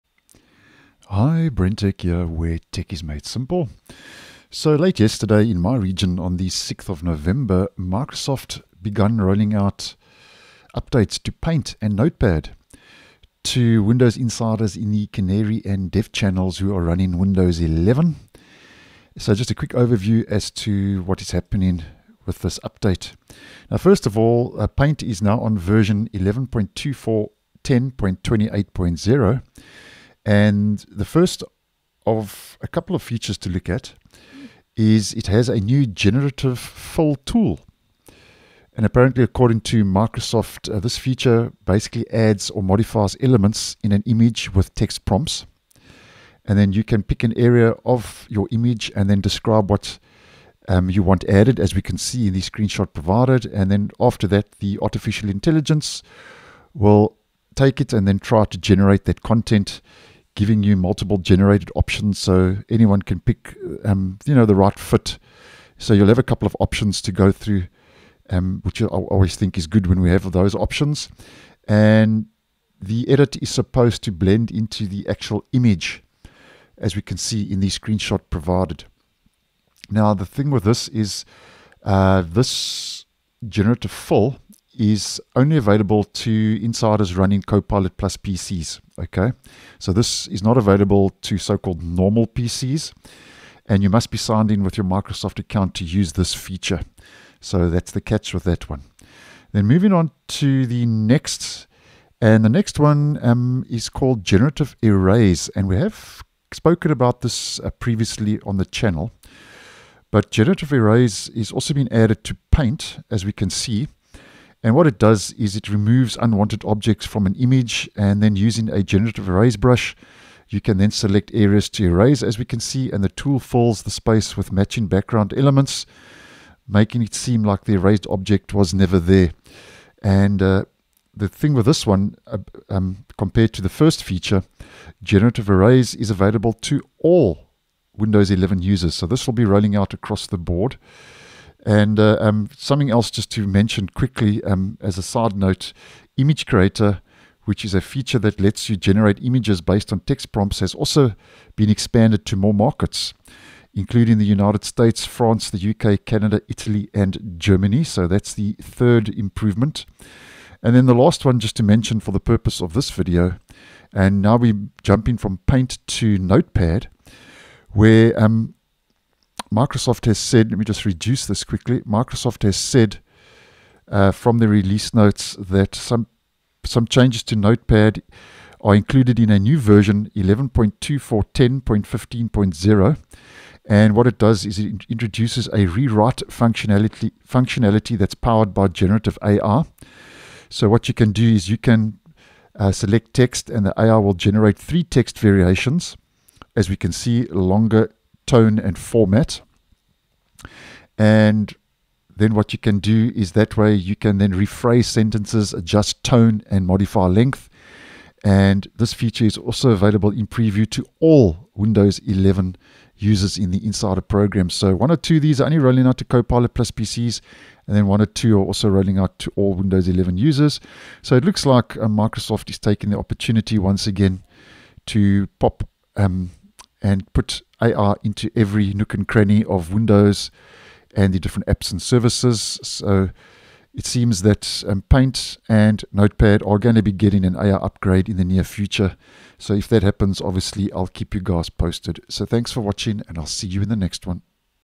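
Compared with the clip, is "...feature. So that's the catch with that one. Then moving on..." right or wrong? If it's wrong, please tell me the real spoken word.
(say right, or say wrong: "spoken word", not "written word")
right.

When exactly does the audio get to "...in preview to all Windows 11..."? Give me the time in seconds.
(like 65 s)
210 s.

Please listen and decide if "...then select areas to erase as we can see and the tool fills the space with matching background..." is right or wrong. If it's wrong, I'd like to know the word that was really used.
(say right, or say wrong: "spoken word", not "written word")
right.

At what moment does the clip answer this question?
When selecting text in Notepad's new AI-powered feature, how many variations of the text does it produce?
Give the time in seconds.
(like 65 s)
194 s.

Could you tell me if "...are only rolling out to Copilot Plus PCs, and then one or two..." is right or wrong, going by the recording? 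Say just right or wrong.
right.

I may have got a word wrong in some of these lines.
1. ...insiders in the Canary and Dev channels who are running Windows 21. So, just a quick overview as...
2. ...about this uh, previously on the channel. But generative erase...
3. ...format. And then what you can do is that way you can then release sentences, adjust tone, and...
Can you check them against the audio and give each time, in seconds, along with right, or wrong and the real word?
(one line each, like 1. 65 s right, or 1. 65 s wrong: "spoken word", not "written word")
1. 14 s wrong: "11", not "21"
2. 106 s right
3. 198 s wrong: "rephrase", not "release".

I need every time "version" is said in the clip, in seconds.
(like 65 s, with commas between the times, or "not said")
25 s, 179 s.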